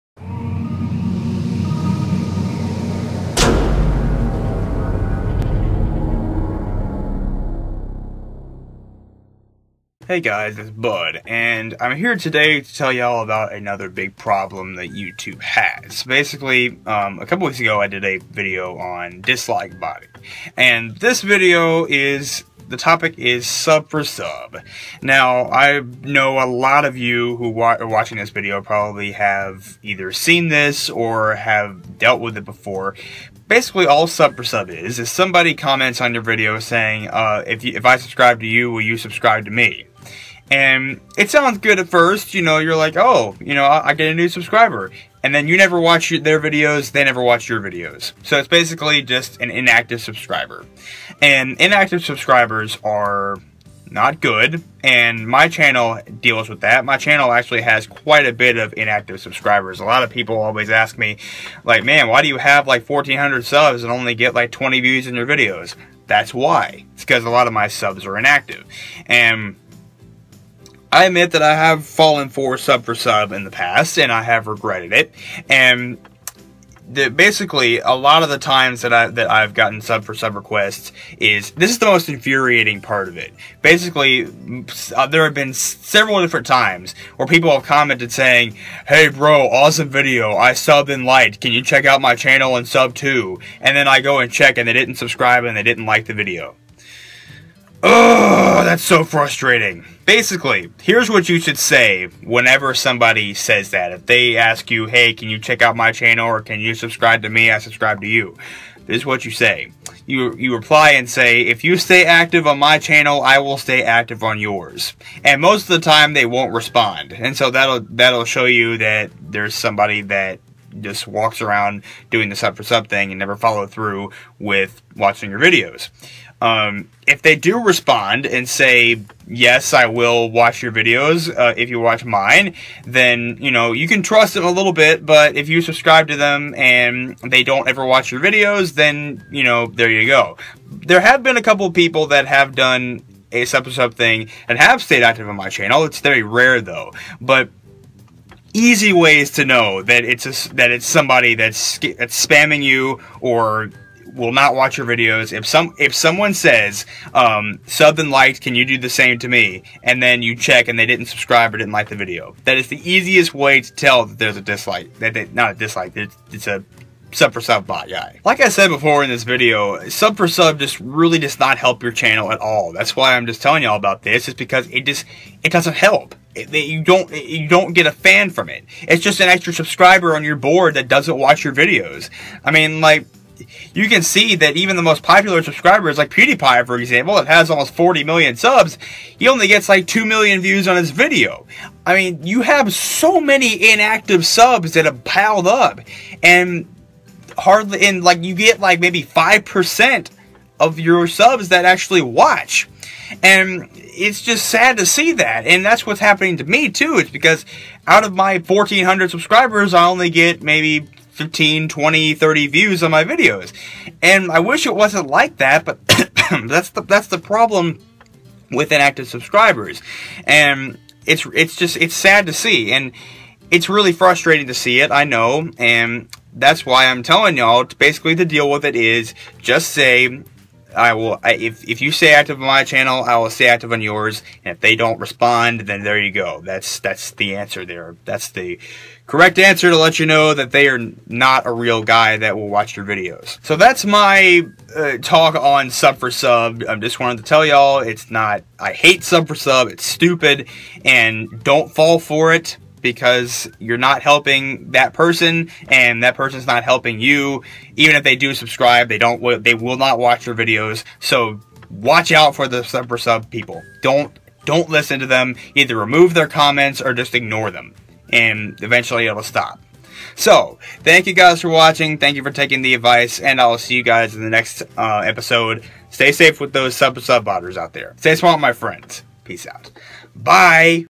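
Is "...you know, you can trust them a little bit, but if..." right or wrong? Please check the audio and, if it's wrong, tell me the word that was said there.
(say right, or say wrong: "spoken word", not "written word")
right.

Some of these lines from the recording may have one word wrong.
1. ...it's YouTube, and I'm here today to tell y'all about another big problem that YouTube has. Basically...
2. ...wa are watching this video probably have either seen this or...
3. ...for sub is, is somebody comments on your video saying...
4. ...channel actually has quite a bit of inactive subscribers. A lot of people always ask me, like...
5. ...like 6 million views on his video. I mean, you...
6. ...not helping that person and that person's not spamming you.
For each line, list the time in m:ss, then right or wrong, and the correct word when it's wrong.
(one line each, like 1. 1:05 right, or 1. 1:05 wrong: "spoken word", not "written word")
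1. 0:10 wrong: "Bud", not "YouTube"
2. 0:27 right
3. 0:34 right
4. 0:56 right
5. 3:09 wrong: "2", not "6"
6. 4:13 wrong: "helping", not "spamming".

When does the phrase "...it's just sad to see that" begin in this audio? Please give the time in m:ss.
3:23.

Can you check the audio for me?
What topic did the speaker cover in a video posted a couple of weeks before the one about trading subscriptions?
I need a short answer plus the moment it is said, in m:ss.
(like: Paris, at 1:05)
dislike body, at 0:19.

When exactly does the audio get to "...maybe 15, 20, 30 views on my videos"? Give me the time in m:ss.
3:30.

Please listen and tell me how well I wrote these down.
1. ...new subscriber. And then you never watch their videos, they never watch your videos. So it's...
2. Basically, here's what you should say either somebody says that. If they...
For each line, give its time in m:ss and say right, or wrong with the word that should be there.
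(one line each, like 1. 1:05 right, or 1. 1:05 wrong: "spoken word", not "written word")
1. 0:44 right
2. 1:40 wrong: "whenever", not "either".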